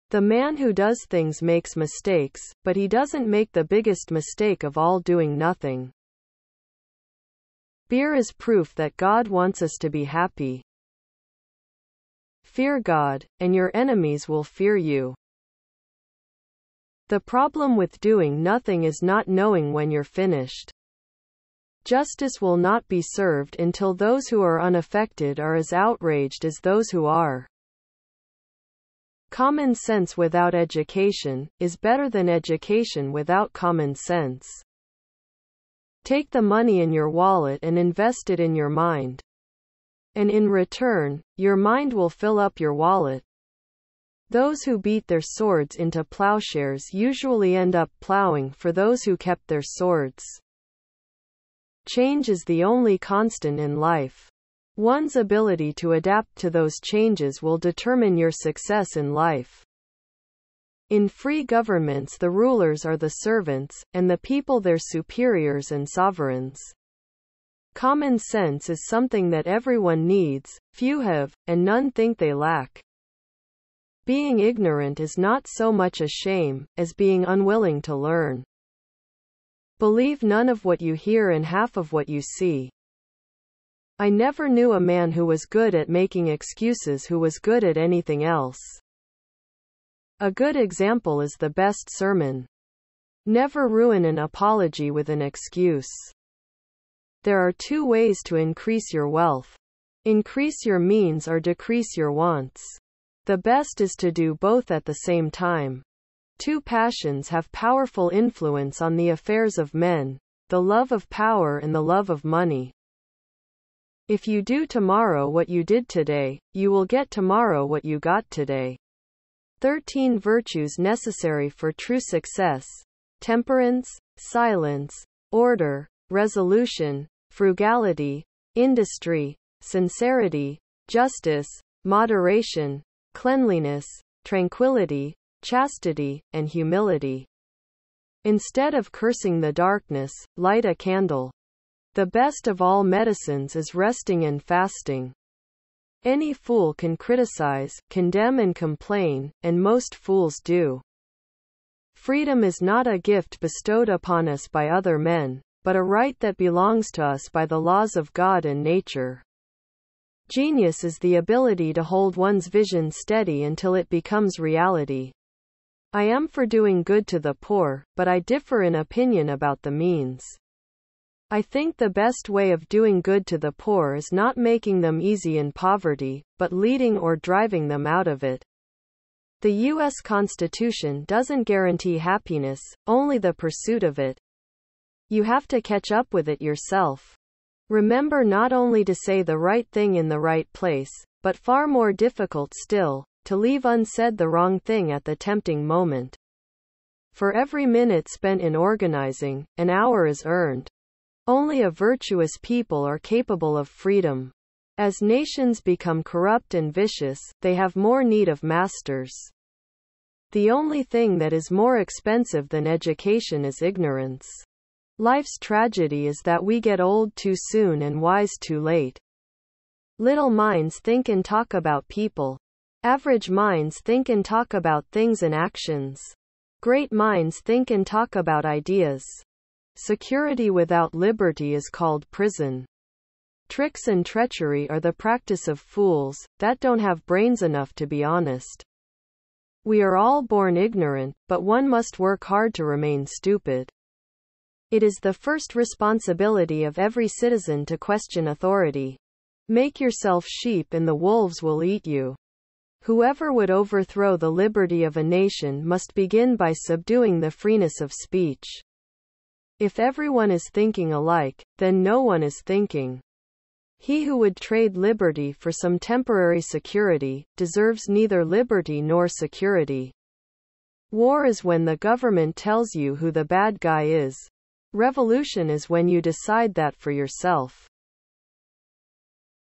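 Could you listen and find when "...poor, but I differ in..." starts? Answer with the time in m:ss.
2:47.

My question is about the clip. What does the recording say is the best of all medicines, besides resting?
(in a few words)
fasting.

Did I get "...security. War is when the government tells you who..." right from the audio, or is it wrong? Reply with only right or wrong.
right.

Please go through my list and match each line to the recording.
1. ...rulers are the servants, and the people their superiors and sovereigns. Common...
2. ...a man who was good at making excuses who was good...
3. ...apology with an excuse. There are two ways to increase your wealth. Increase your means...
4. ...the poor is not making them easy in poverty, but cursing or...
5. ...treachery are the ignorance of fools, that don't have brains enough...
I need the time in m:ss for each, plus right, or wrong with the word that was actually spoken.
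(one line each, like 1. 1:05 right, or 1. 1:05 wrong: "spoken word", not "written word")
1. 1:02 right
2. 1:24 right
3. 1:34 right
4. 2:53 wrong: "leading", not "cursing"
5. 3:54 wrong: "practice", not "ignorance".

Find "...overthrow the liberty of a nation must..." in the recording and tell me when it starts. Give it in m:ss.
4:13.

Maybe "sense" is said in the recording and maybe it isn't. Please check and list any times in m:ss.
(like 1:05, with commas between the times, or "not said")
0:29, 0:33, 1:08.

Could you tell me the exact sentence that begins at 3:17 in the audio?
For every minute spent in organizing, an hour is earned.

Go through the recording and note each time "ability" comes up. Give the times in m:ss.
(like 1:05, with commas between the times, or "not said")
0:55, 2:41.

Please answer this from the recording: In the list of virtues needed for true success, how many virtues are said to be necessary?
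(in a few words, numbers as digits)
13.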